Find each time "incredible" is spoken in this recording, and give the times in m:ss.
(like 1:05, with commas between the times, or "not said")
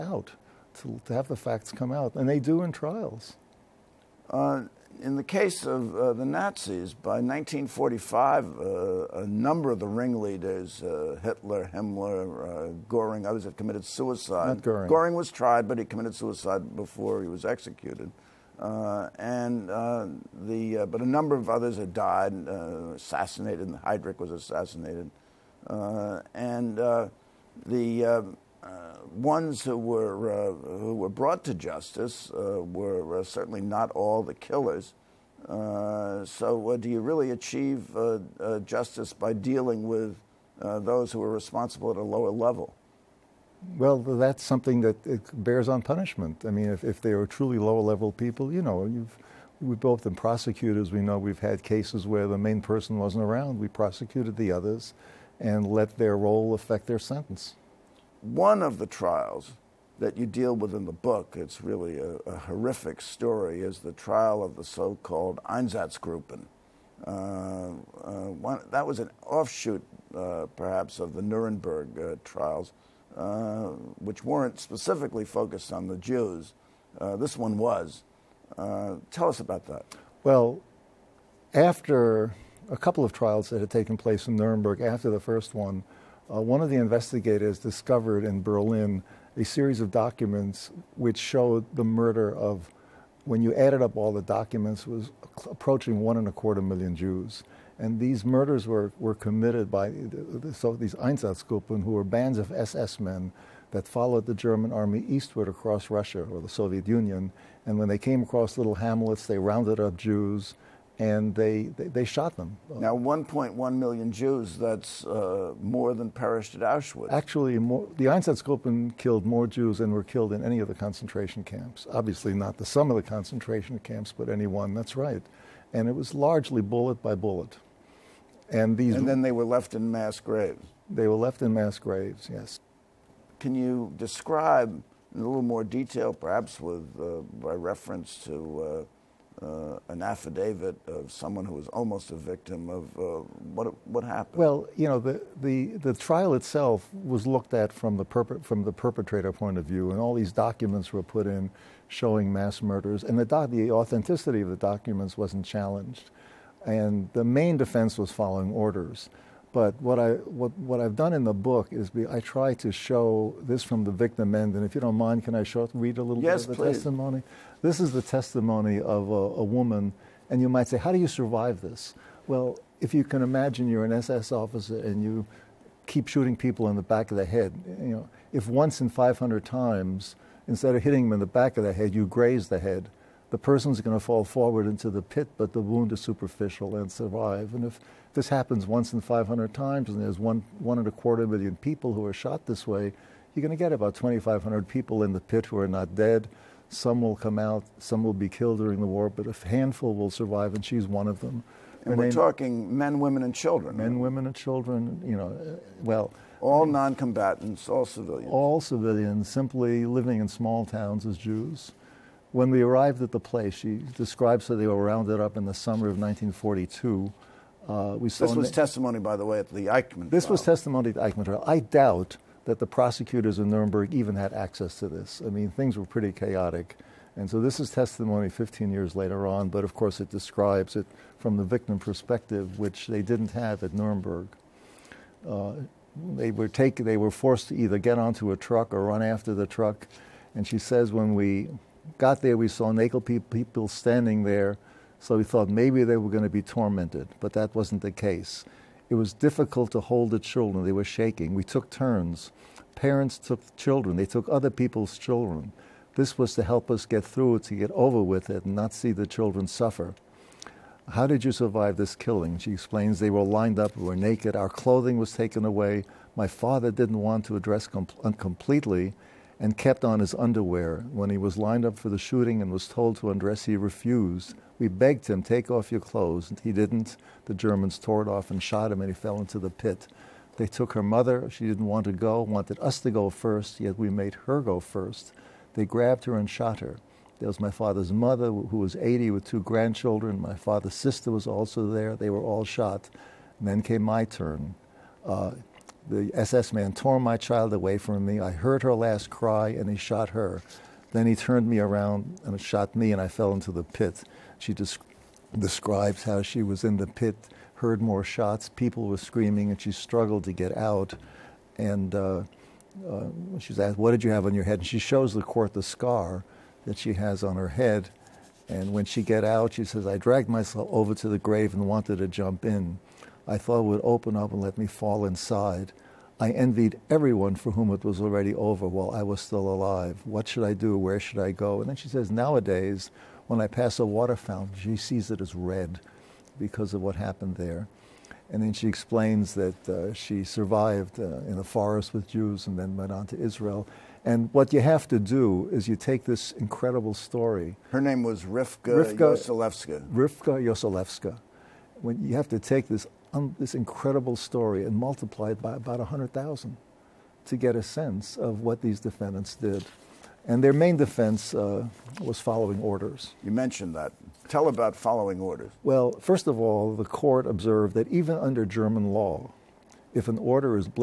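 5:46, 5:53.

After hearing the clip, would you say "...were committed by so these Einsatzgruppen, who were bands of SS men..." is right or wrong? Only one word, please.
right.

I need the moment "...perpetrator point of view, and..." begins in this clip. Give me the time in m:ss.
2:28.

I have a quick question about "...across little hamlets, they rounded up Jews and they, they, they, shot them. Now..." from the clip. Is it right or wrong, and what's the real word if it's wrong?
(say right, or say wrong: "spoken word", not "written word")
right.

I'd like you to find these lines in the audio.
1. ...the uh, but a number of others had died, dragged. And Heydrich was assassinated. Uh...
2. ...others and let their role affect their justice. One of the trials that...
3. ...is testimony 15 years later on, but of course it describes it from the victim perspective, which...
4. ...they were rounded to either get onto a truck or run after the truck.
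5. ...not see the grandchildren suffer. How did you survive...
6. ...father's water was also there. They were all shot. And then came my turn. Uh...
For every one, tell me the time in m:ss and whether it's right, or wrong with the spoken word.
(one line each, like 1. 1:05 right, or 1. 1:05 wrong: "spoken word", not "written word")
1. 0:20 wrong: "assassinated", not "dragged"
2. 0:54 wrong: "sentence", not "justice"
3. 3:47 right
4. 3:56 wrong: "forced", not "rounded"
5. 4:18 wrong: "children", not "grandchildren"
6. 4:50 wrong: "sister", not "water".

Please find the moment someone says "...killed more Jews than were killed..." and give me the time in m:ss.
1:58.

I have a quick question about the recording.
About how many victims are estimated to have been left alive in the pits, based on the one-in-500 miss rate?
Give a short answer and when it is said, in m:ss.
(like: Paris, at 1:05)
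2,500, at 3:13.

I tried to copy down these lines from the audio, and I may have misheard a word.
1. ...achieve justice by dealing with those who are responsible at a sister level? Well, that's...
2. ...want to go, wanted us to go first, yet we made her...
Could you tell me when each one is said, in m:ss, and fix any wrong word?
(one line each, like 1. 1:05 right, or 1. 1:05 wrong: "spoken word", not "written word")
1. 0:37 wrong: "lower", not "sister"
2. 4:41 right.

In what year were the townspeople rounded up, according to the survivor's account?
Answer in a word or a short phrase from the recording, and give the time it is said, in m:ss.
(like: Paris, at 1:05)
1942, at 3:35.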